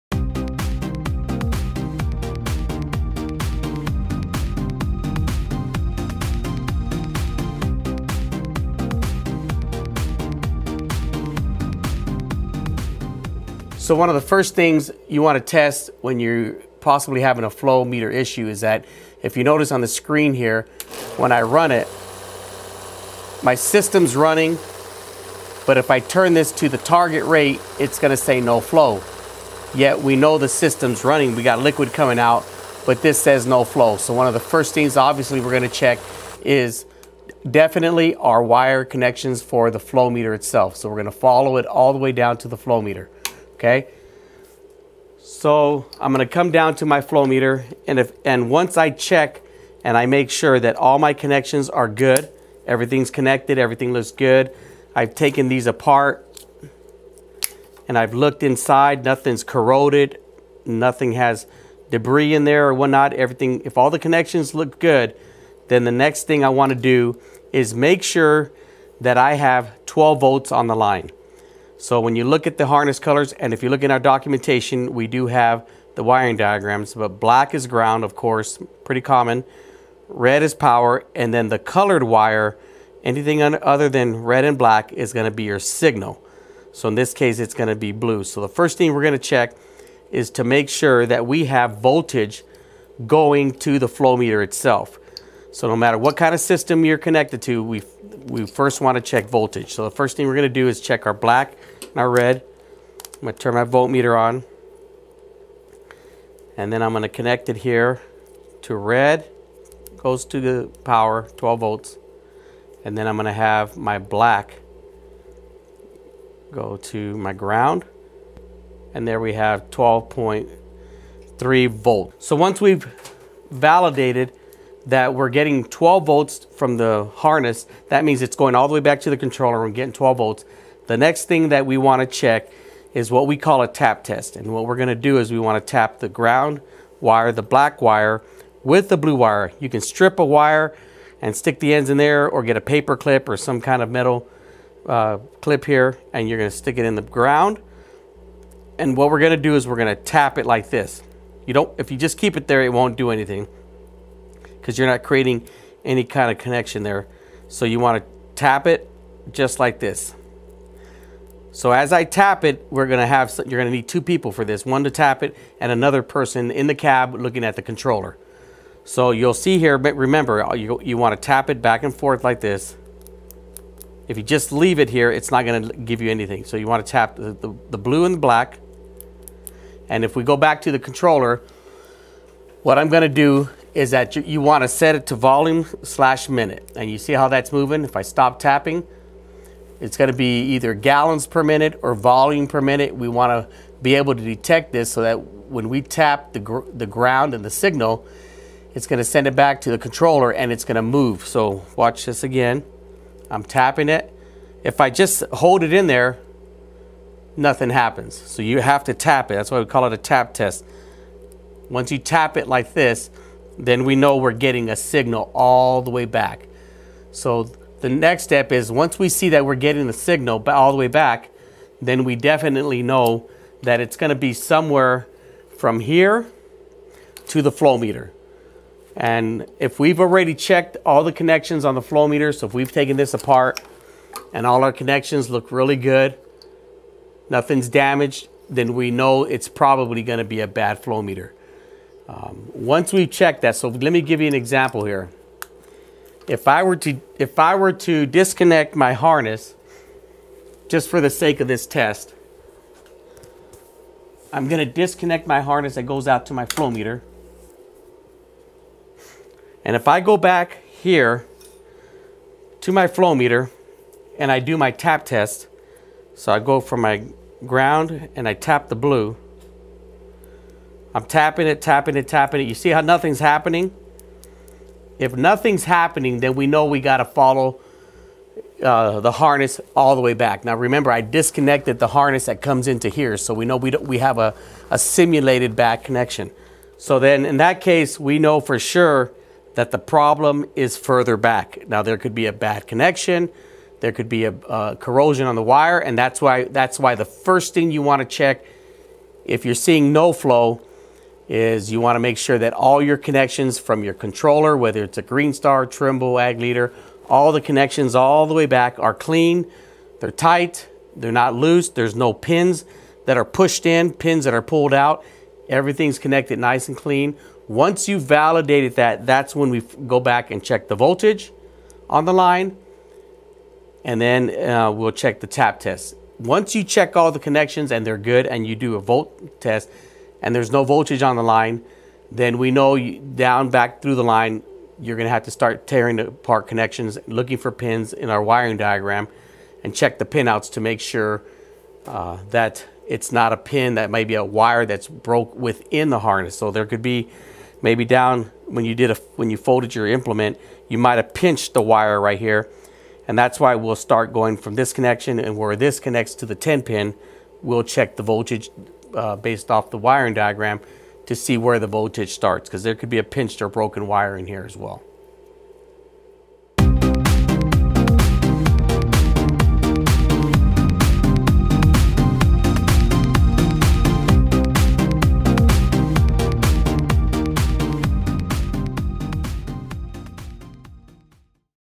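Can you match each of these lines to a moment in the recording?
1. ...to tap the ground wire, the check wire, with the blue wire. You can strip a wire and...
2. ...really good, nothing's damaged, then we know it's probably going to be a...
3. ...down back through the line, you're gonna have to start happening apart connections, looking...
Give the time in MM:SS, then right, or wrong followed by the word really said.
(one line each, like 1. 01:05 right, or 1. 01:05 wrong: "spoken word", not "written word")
1. 02:15 wrong: "black", not "check"
2. 03:55 right
3. 05:33 wrong: "tearing", not "happening".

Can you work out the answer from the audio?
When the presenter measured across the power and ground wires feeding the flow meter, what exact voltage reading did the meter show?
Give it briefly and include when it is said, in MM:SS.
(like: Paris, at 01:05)
12.3 volts, at 01:59.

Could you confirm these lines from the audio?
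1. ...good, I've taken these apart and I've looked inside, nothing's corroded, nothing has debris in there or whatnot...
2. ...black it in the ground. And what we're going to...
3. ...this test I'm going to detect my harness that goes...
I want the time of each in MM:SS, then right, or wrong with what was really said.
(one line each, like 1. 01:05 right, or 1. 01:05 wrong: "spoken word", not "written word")
1. 00:54 right
2. 02:26 wrong: "stick", not "black"
3. 04:11 wrong: "disconnect", not "detect".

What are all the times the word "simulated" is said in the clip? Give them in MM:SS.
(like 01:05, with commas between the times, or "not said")
04:44.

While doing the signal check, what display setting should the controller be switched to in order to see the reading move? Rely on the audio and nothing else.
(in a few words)
Volume per minute.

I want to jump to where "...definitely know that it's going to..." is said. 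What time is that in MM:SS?
03:42.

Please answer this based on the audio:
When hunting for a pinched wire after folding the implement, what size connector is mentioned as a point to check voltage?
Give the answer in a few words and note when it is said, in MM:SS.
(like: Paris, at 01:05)
10 pin, at 05:56.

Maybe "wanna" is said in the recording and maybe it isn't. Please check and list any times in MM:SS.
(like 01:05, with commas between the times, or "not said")
01:06, 01:38, 02:50, 02:56, 03:04, 04:57.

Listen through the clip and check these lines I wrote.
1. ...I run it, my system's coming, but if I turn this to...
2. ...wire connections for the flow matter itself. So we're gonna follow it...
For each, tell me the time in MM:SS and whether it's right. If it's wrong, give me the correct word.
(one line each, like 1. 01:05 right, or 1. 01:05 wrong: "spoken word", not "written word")
1. 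00:21 wrong: "running", not "coming"
2. 00:38 wrong: "meter", not "matter".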